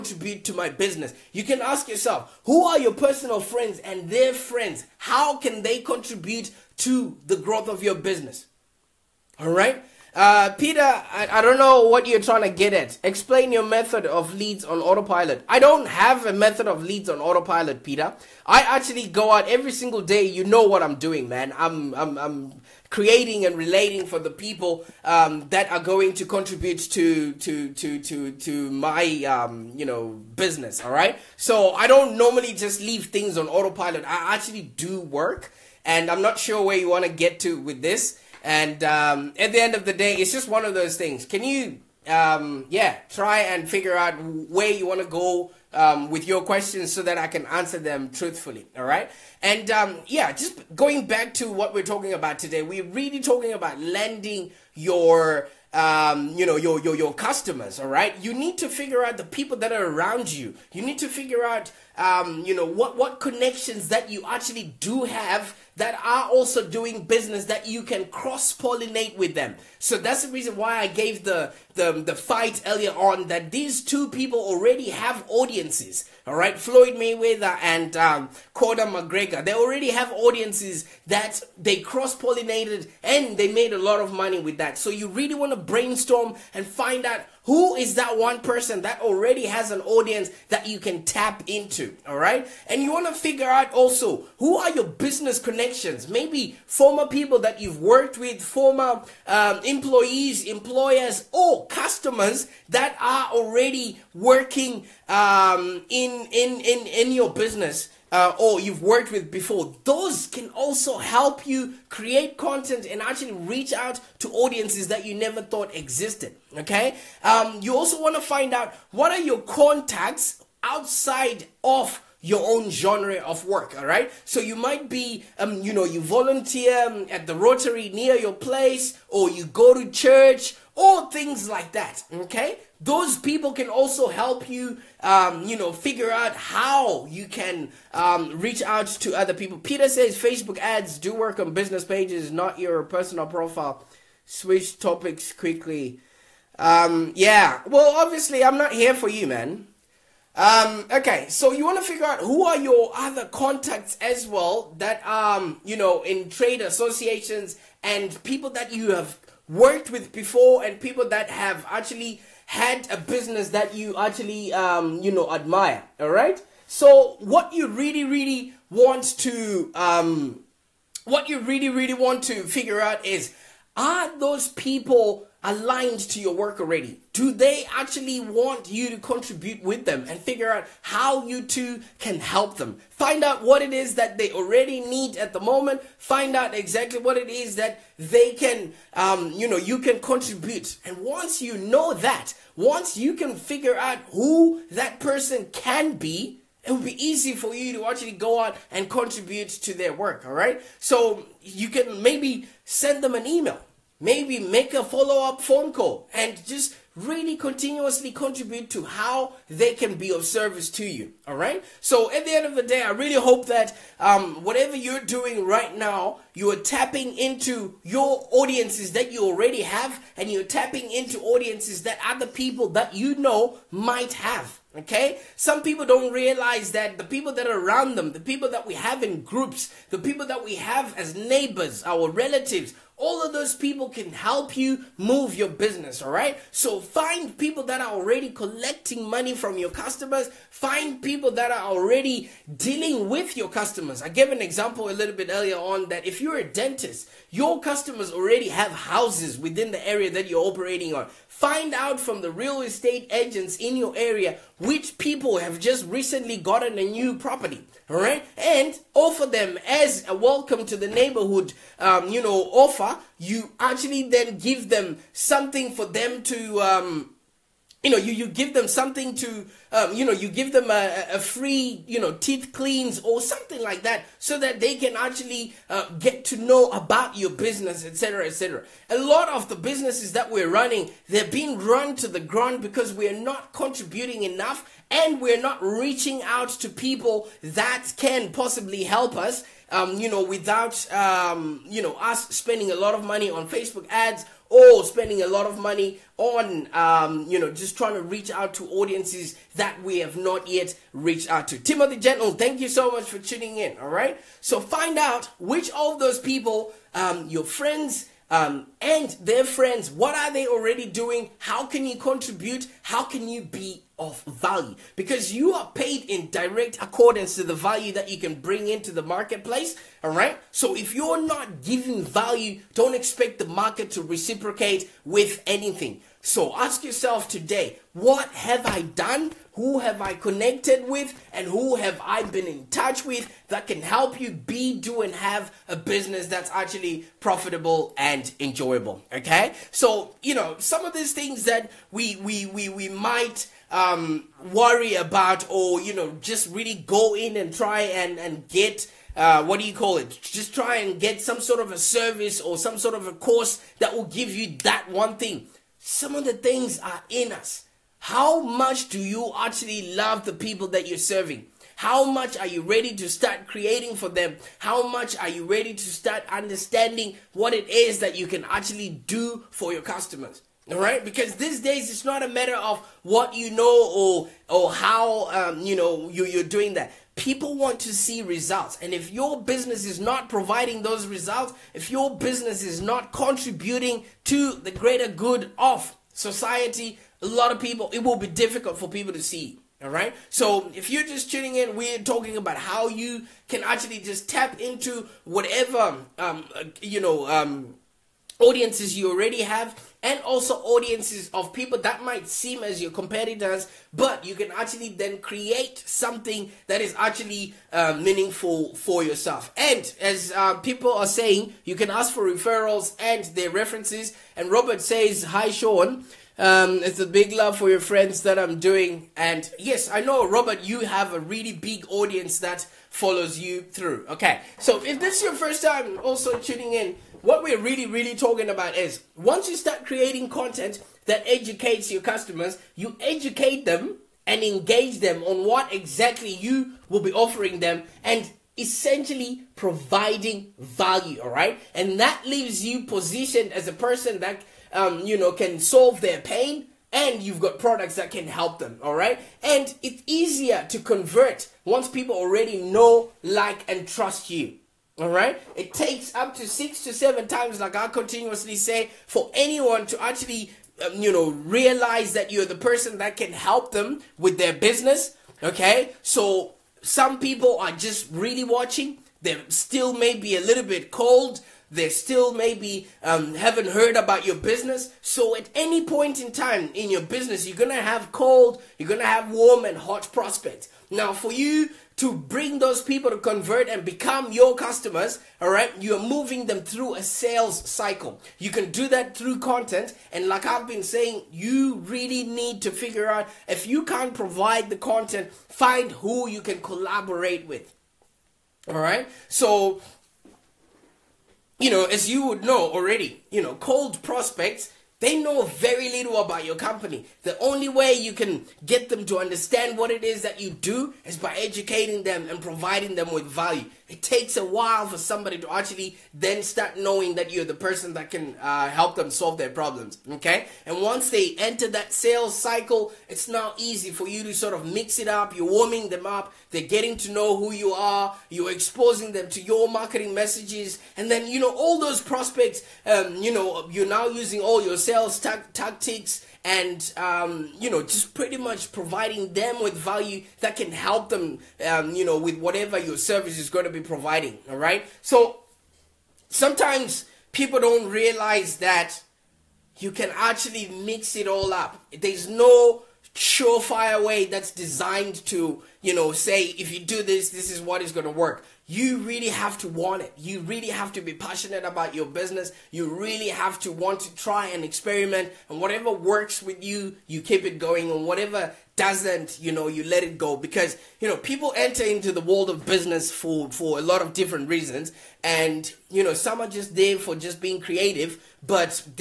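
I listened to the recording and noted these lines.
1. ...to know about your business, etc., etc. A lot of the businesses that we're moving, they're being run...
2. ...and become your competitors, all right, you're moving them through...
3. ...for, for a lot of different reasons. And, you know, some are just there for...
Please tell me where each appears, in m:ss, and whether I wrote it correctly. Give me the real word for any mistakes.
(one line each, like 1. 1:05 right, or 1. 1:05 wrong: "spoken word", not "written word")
1. 4:36 wrong: "running", not "moving"
2. 8:03 wrong: "customers", not "competitors"
3. 9:33 right.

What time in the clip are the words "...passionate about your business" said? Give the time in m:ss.
9:21.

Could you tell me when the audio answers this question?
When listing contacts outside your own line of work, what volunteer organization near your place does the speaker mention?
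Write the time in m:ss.
2:07.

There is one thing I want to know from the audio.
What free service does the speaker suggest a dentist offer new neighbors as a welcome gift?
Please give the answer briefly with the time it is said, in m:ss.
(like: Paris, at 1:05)
teeth cleans, at 4:32.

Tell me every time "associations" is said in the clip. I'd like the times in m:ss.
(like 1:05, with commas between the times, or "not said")
2:36.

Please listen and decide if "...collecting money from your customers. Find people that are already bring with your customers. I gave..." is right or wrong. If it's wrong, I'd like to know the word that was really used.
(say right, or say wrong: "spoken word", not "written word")
wrong: "dealing", not "bring".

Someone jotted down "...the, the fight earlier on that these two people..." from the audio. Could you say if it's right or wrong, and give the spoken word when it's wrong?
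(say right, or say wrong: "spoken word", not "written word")
right.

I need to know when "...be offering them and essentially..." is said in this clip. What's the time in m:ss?
7:17.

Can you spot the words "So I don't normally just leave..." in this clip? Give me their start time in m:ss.
0:31.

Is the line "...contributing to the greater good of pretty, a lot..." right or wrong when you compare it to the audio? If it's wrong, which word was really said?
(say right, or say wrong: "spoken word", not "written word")
wrong: "society", not "pretty".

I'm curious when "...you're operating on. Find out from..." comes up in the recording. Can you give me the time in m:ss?
4:10.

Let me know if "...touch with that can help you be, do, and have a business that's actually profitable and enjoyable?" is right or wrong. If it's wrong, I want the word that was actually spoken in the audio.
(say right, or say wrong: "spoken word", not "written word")
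right.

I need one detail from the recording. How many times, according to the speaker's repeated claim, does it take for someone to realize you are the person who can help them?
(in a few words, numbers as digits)
6 to 7.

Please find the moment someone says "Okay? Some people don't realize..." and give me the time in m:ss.
3:44.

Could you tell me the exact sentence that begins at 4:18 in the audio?
And offer them as a welcome to the neighborhood, um, you know, offer.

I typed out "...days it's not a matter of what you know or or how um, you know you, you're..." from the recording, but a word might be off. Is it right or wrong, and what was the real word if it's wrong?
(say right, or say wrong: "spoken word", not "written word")
right.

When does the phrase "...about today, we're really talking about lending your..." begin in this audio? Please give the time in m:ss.
0:52.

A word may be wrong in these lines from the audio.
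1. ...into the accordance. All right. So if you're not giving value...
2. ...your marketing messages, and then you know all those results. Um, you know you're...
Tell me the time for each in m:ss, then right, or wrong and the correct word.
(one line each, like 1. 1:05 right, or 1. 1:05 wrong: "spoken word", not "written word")
1. 5:18 wrong: "marketplace", not "accordance"
2. 8:49 wrong: "prospects", not "results".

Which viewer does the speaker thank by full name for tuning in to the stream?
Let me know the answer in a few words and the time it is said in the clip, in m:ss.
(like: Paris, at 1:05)
Timothy Gentle, at 5:01.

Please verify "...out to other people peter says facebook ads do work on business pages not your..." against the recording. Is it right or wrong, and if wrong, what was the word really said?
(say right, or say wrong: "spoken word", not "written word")
right.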